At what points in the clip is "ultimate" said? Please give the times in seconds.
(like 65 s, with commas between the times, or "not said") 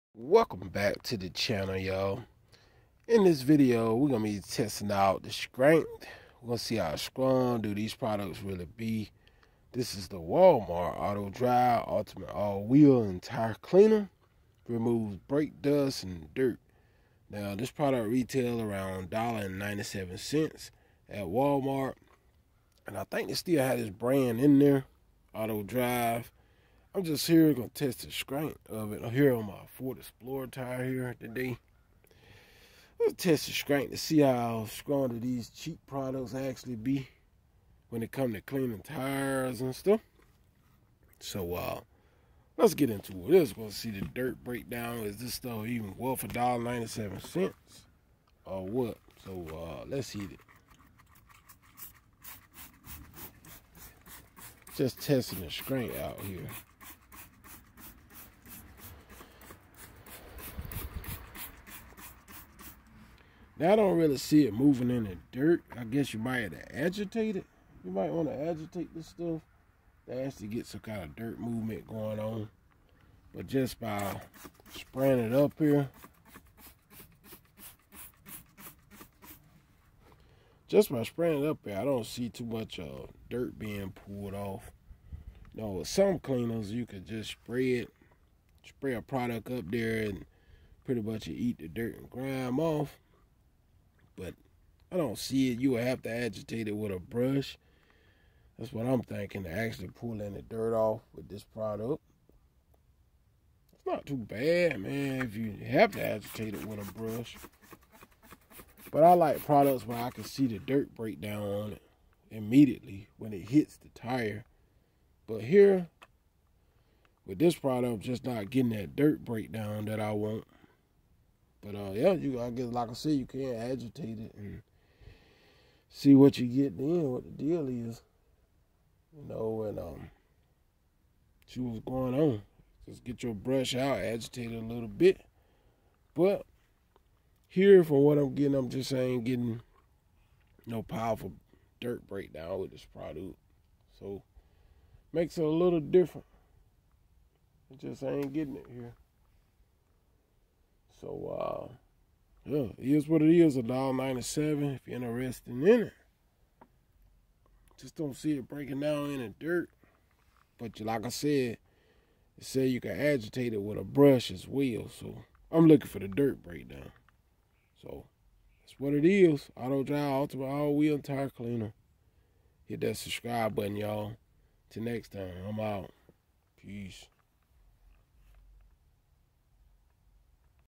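11 s, 170 s.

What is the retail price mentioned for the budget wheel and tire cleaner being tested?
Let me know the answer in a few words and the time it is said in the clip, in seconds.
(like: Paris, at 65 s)
$1.97, at 19 s.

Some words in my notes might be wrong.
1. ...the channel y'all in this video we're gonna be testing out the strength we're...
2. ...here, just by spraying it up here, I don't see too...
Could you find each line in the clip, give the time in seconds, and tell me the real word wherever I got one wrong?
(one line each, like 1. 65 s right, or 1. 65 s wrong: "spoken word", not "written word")
1. 1 s right
2. 75 s right.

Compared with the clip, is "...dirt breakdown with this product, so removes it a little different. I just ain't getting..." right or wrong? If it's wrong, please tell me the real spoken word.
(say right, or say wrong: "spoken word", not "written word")
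wrong: "makes", not "removes".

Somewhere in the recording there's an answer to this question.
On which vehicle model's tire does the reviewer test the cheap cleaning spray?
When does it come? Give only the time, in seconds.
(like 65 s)
29 s.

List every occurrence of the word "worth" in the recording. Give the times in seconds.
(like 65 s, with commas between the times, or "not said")
45 s.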